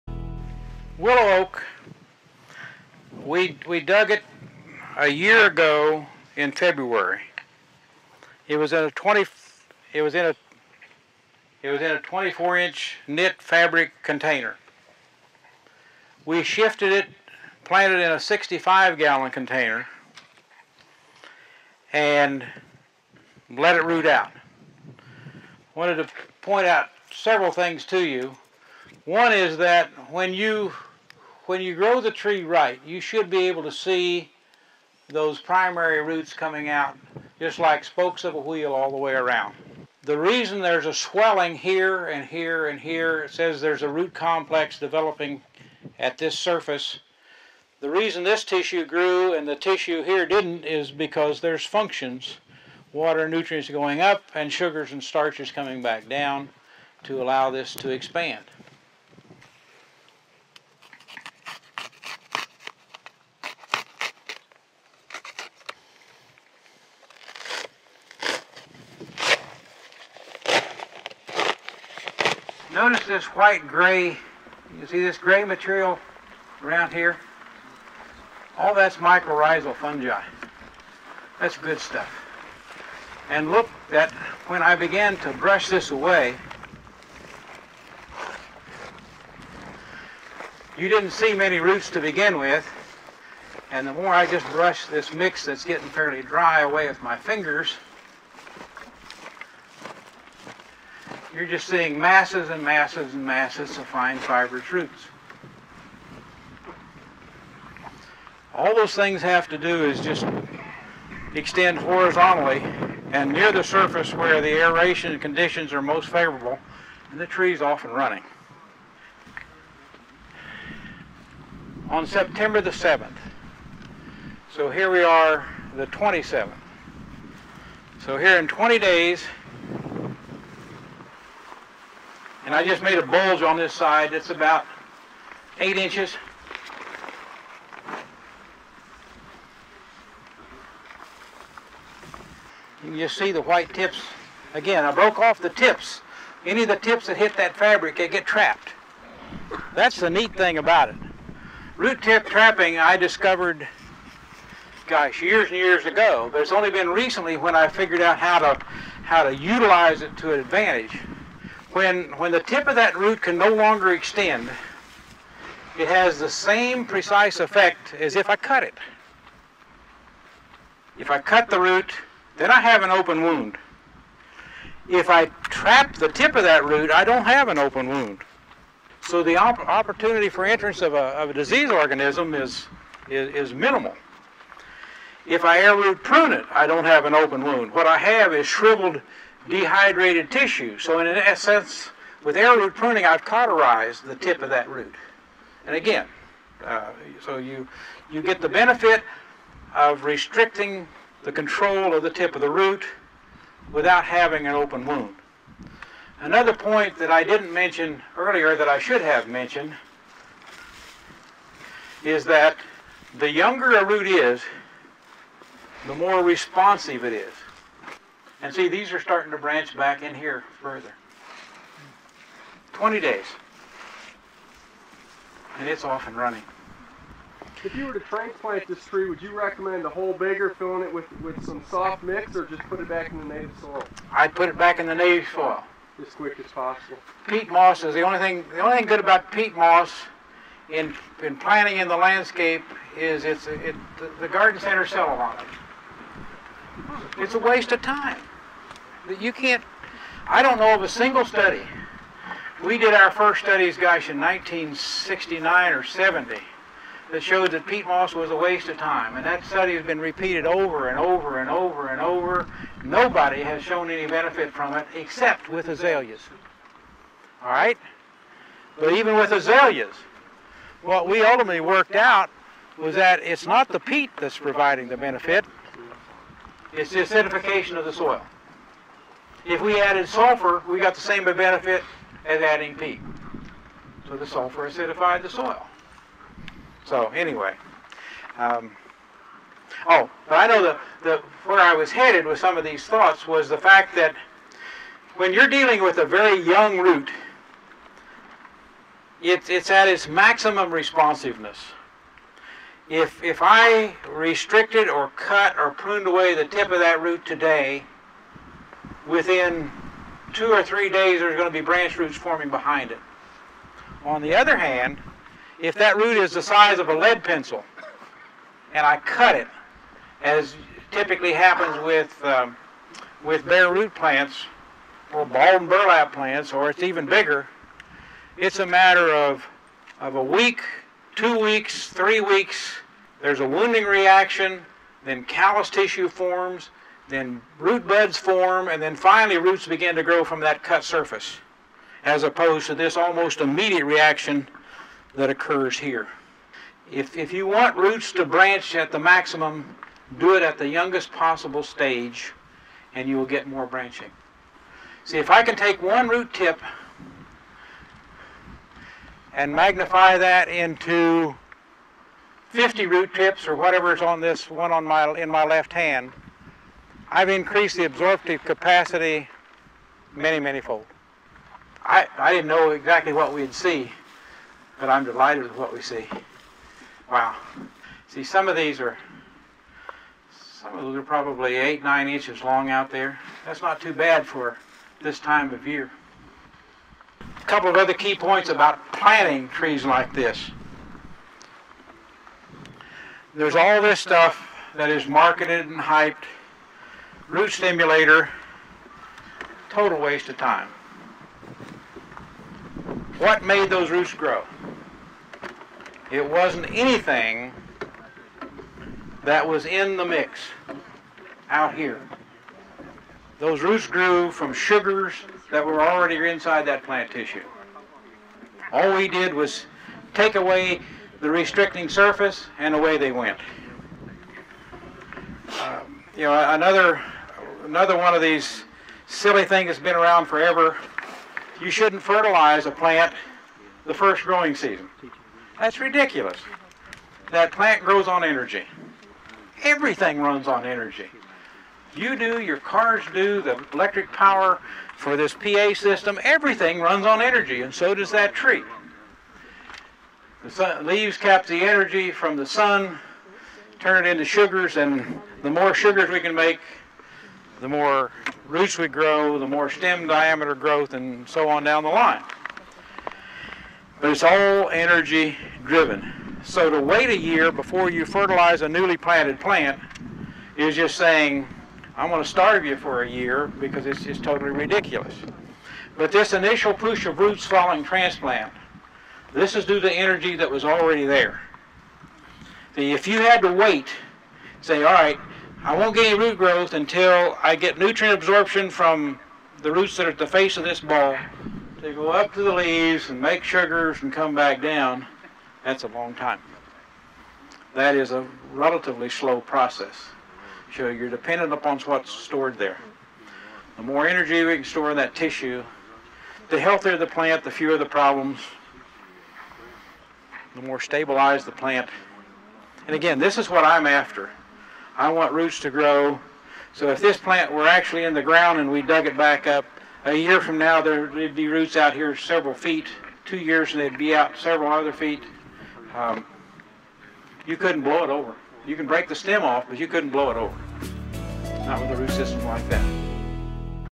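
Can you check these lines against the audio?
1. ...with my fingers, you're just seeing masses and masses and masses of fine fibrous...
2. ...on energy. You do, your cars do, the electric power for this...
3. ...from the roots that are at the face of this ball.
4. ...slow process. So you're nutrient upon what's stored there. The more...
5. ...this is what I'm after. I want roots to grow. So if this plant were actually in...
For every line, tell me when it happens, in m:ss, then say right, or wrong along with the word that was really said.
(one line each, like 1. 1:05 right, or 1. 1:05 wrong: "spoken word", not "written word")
1. 1:36 right
2. 7:20 right
3. 8:08 right
4. 8:19 wrong: "dependent", not "nutrient"
5. 8:33 right.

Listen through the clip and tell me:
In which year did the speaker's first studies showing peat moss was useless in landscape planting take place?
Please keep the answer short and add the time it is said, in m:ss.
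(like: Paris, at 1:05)
1969, at 4:14.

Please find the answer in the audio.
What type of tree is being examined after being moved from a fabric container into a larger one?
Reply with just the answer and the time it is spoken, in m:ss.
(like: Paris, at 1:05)
Willow oak, at 0:01.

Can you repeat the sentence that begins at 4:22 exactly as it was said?
Nobody has shown any benefit from it except with azaleas.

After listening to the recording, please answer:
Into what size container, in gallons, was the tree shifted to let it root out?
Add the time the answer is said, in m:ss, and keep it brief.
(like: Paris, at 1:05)
65 gallon, at 0:18.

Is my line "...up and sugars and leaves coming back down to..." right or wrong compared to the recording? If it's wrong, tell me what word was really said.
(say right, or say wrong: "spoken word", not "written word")
wrong: "starches", not "leaves".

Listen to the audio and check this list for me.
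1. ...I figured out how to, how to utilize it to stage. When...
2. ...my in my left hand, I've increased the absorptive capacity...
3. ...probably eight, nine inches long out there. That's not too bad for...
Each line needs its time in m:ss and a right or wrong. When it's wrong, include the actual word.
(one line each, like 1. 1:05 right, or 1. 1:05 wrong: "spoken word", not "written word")
1. 2:37 wrong: "advantage", not "stage"
2. 6:04 right
3. 6:21 right.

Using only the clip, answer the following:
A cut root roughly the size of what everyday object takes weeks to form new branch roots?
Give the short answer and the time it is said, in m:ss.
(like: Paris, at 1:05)
A lead pencil, at 5:16.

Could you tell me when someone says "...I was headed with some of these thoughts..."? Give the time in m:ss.
4:51.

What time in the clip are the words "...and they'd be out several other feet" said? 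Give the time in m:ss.
8:43.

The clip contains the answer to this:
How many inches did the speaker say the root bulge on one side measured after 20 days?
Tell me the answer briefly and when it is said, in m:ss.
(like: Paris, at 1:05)
8 inches, at 2:14.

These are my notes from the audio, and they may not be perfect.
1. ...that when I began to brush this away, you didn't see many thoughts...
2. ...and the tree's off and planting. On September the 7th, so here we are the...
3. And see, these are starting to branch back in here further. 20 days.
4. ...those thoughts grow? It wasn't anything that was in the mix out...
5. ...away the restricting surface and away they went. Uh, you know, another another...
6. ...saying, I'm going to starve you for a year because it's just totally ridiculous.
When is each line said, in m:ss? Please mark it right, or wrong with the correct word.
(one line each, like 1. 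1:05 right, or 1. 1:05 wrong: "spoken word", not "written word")
1. 1:23 wrong: "roots", not "thoughts"
2. 1:57 wrong: "running", not "planting"
3. 3:38 right
4. 6:43 wrong: "roots", not "thoughts"
5. 7:00 right
6. 7:50 right.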